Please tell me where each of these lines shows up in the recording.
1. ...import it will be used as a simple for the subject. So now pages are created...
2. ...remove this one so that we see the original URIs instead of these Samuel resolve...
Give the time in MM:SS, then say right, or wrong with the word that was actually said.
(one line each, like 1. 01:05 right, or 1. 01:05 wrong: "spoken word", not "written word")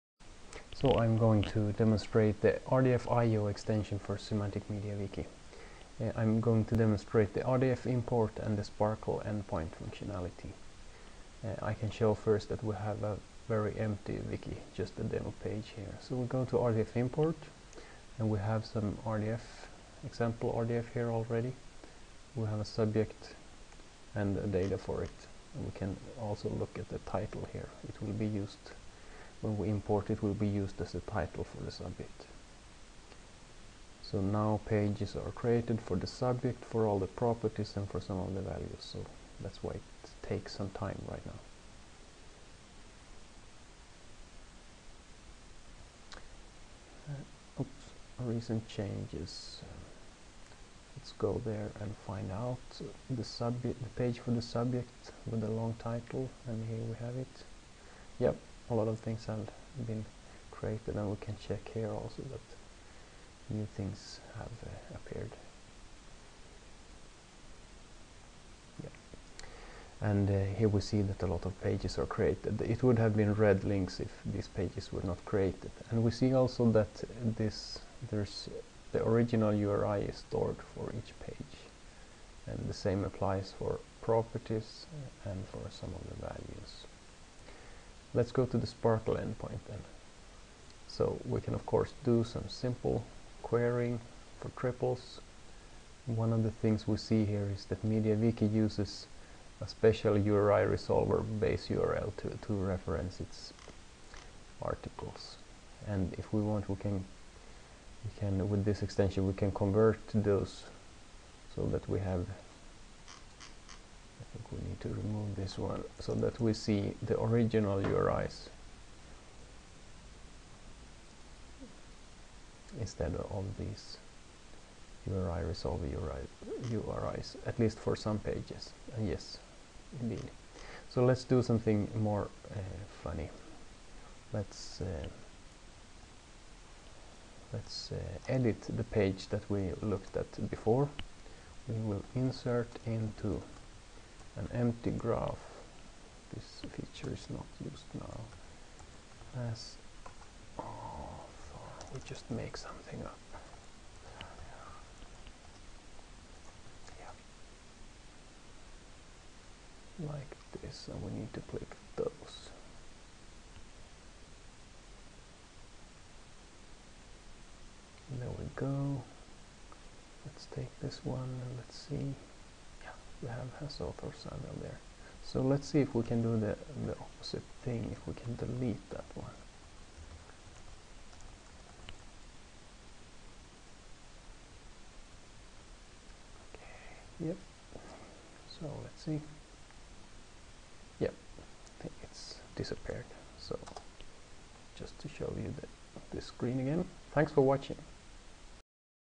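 1. 00:29 wrong: "title", not "simple"
2. 01:54 wrong: "URI", not "Samuel".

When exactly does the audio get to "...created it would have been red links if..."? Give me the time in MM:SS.
01:12.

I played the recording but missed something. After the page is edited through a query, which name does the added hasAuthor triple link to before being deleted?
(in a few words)
Samuel.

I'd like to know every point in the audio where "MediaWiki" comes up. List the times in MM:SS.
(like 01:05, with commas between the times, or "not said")
00:04, 01:37.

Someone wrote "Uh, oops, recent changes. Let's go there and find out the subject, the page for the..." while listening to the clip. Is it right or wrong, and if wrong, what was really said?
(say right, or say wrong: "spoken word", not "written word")
right.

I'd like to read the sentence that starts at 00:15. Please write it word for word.
So we go to RDF import and we have some RDF, example RDF here already.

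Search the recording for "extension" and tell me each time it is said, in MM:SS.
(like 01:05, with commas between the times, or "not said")
00:03, 01:48.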